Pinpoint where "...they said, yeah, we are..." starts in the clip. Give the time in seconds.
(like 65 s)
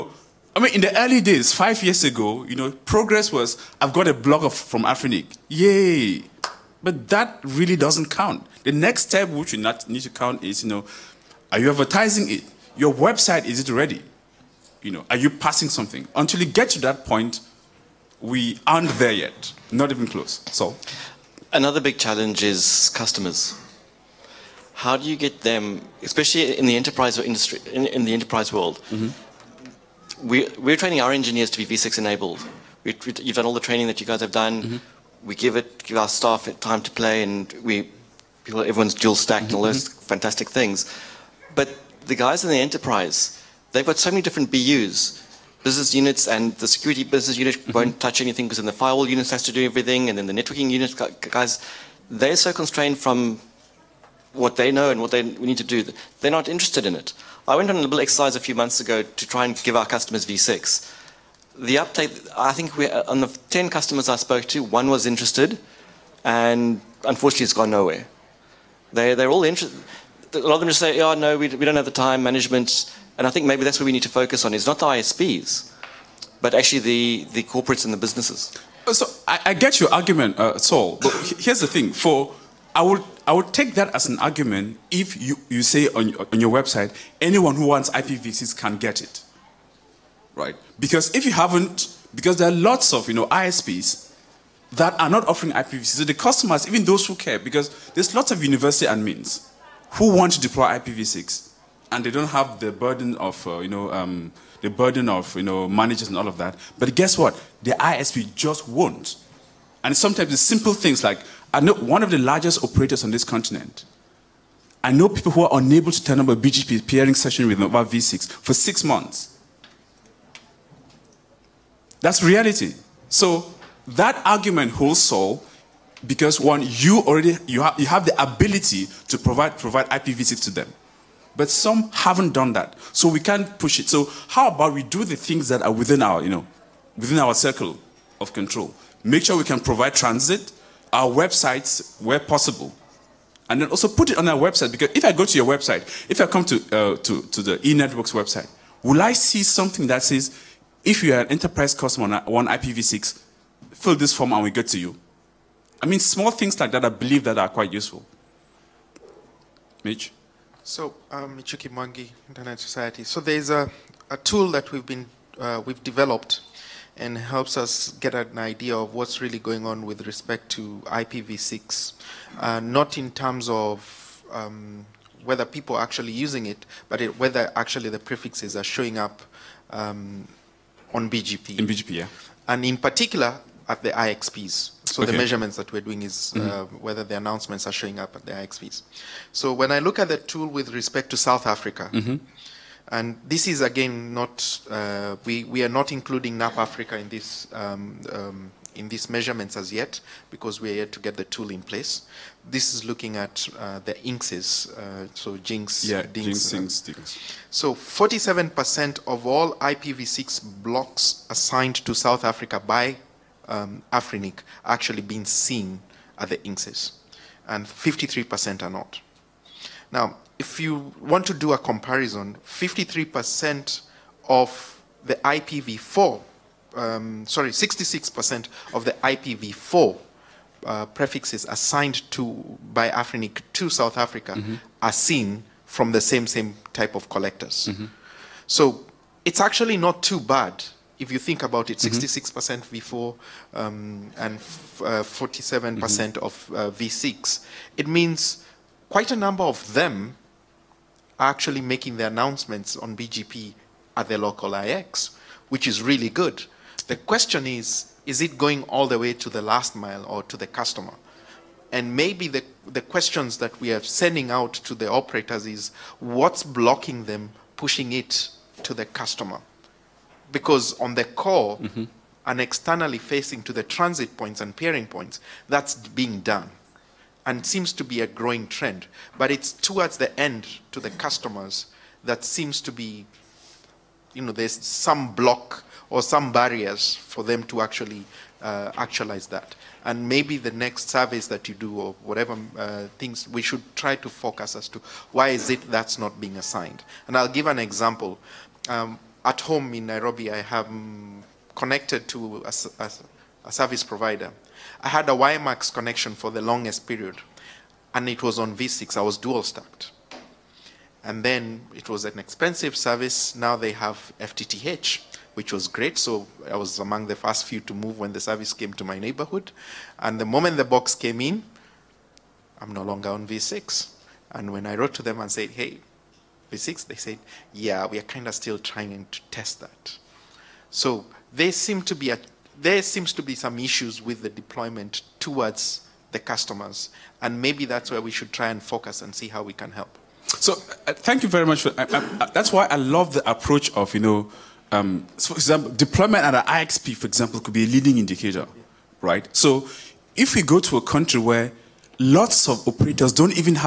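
326 s.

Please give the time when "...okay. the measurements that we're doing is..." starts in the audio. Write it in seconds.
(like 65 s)
185 s.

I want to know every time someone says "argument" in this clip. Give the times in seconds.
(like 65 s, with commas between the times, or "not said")
79 s, 84 s, 124 s.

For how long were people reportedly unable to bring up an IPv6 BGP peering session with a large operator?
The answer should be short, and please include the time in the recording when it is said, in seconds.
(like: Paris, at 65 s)
six months, at 118 s.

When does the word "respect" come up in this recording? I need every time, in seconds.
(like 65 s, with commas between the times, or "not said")
170 s, 190 s.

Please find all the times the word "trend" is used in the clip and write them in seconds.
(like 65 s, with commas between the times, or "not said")
278 s.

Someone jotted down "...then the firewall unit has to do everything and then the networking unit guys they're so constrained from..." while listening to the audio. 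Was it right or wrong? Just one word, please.
right.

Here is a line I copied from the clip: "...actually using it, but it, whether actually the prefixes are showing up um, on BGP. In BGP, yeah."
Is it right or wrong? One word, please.
right.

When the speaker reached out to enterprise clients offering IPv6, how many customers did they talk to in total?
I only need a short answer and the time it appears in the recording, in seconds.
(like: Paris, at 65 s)
10, at 63 s.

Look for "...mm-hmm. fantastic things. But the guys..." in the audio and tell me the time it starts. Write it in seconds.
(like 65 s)
39 s.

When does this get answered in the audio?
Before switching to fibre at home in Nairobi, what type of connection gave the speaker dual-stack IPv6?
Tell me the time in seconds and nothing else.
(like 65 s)
305 s.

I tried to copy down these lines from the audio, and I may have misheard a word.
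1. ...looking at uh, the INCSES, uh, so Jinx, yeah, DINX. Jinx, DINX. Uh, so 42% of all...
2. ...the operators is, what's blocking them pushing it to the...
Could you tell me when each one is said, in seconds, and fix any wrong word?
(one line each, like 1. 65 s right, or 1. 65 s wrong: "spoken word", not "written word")
1. 202 s wrong: "47", not "42"
2. 264 s right.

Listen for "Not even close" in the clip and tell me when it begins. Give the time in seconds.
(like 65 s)
19 s.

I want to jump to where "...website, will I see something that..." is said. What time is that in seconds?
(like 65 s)
148 s.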